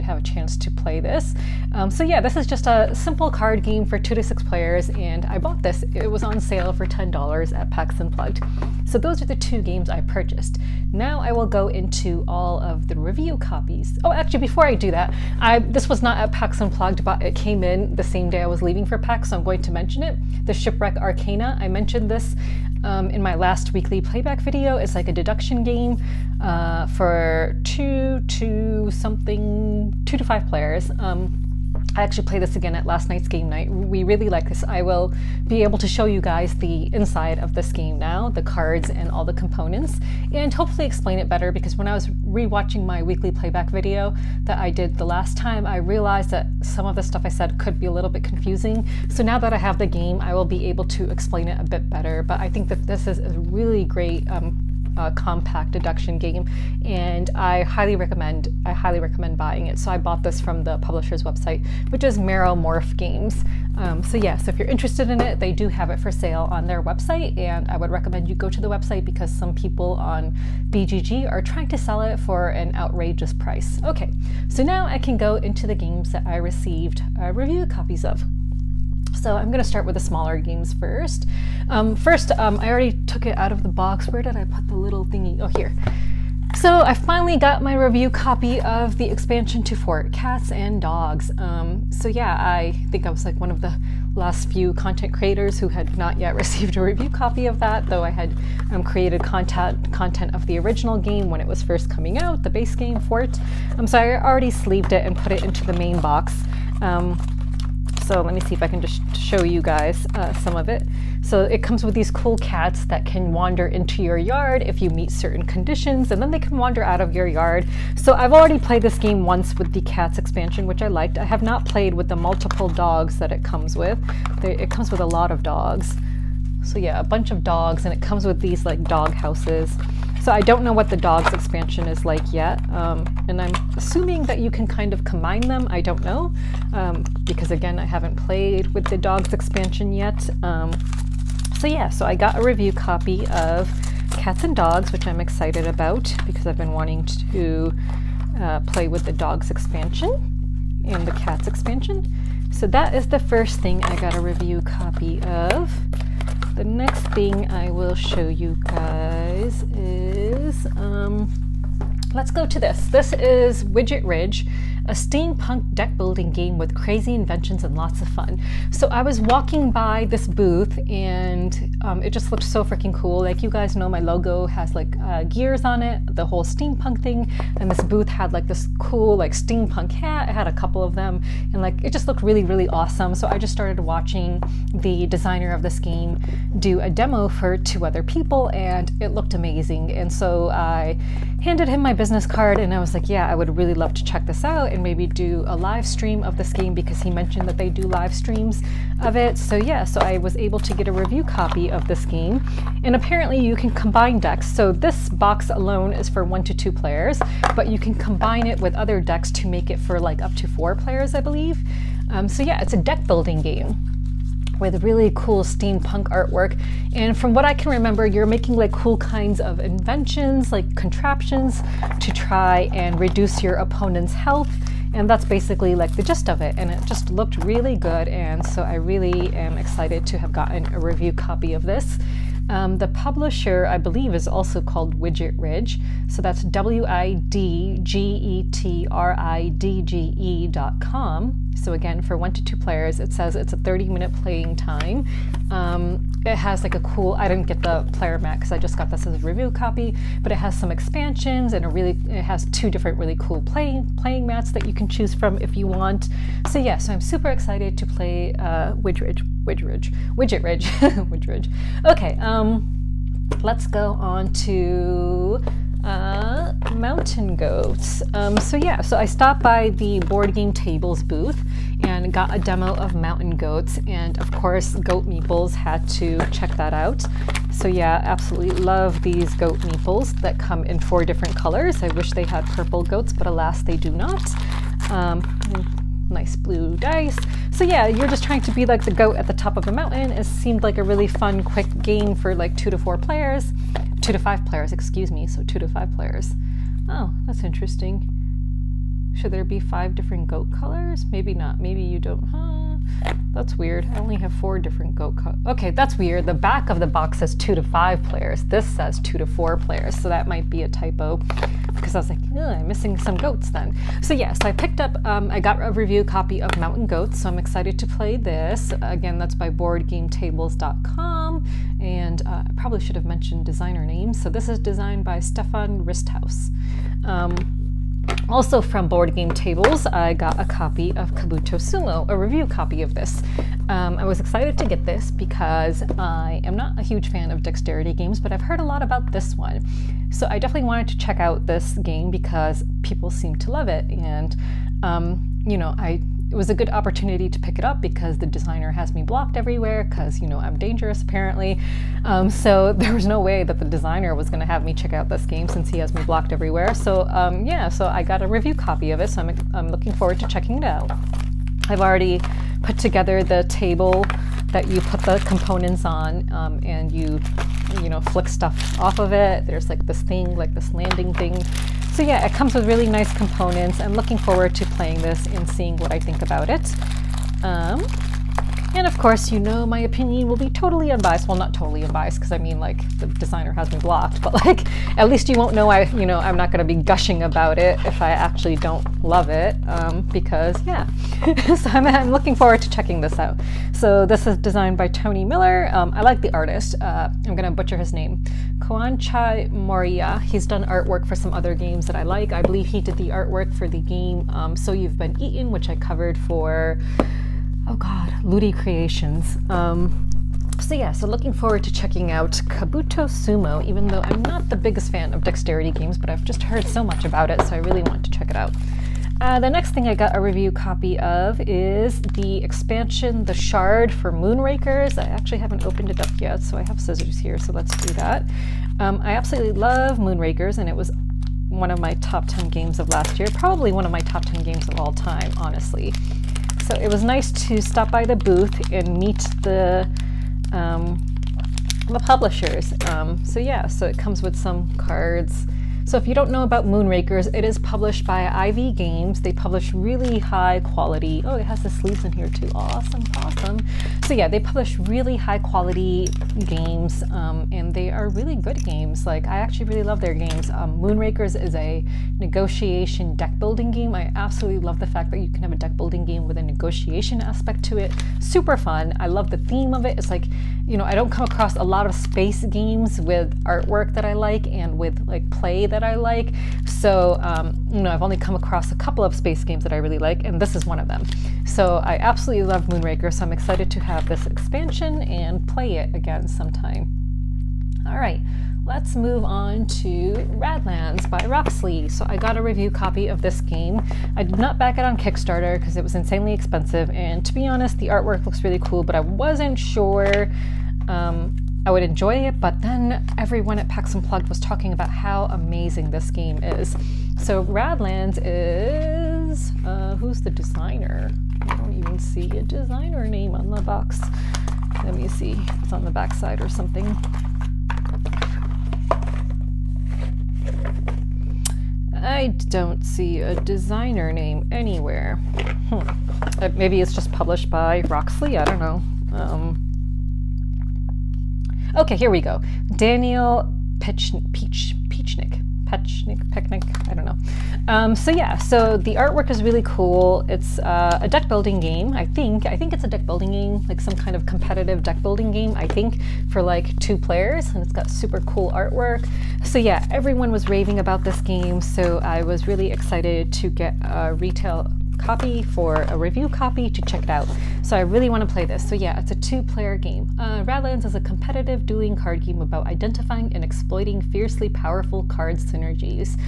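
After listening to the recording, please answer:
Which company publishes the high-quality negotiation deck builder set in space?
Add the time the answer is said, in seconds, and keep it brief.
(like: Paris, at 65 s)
Ivy Games, at 448 s.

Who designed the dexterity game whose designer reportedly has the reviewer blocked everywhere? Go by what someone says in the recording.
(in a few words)
Tony Miller.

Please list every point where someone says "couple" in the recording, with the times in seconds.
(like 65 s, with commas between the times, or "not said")
180 s, 478 s.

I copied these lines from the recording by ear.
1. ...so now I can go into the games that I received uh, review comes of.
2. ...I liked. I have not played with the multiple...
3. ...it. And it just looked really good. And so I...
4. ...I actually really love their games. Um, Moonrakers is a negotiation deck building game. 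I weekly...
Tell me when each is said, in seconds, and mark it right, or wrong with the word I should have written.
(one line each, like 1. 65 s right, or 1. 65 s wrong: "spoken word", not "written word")
1. 74 s wrong: "copies", not "comes"
2. 120 s right
3. 226 s right
4. 459 s wrong: "absolutely", not "weekly".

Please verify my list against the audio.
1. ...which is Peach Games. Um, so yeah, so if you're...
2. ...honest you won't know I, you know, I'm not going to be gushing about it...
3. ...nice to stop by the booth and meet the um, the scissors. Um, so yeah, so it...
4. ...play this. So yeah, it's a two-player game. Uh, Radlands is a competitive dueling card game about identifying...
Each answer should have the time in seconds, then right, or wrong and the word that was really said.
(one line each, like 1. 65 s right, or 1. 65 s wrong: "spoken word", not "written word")
1. 61 s wrong: "Meromorph", not "Peach"
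2. 385 s wrong: "least", not "honest"
3. 437 s wrong: "publishers", not "scissors"
4. 558 s right.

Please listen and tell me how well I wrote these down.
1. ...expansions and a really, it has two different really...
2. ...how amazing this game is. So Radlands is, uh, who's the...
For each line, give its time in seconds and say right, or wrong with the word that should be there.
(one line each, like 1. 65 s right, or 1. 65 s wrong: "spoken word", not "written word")
1. 250 s right
2. 504 s right.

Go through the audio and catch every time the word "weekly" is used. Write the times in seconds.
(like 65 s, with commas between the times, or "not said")
23 s, 43 s.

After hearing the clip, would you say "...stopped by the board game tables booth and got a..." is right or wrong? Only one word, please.
right.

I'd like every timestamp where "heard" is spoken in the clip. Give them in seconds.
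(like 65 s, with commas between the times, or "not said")
338 s, 416 s.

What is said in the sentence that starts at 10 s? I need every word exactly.
Now I will go into all of the review copies.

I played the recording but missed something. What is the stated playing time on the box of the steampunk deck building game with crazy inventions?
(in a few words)
30 minutes.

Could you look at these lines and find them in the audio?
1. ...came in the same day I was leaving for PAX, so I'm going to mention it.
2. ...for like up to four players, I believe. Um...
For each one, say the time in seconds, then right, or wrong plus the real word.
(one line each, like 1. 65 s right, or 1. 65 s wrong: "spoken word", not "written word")
1. 17 s right
2. 209 s right.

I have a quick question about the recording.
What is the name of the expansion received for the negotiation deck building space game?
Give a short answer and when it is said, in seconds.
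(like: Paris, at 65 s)
The Shard, at 423 s.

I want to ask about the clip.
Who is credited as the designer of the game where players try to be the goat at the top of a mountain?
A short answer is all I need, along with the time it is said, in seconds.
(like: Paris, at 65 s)
Stefan Risthaus, at 325 s.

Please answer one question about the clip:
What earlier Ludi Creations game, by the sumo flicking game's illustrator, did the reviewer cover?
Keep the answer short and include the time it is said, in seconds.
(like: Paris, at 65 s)
So You've Been Eaten, at 404 s.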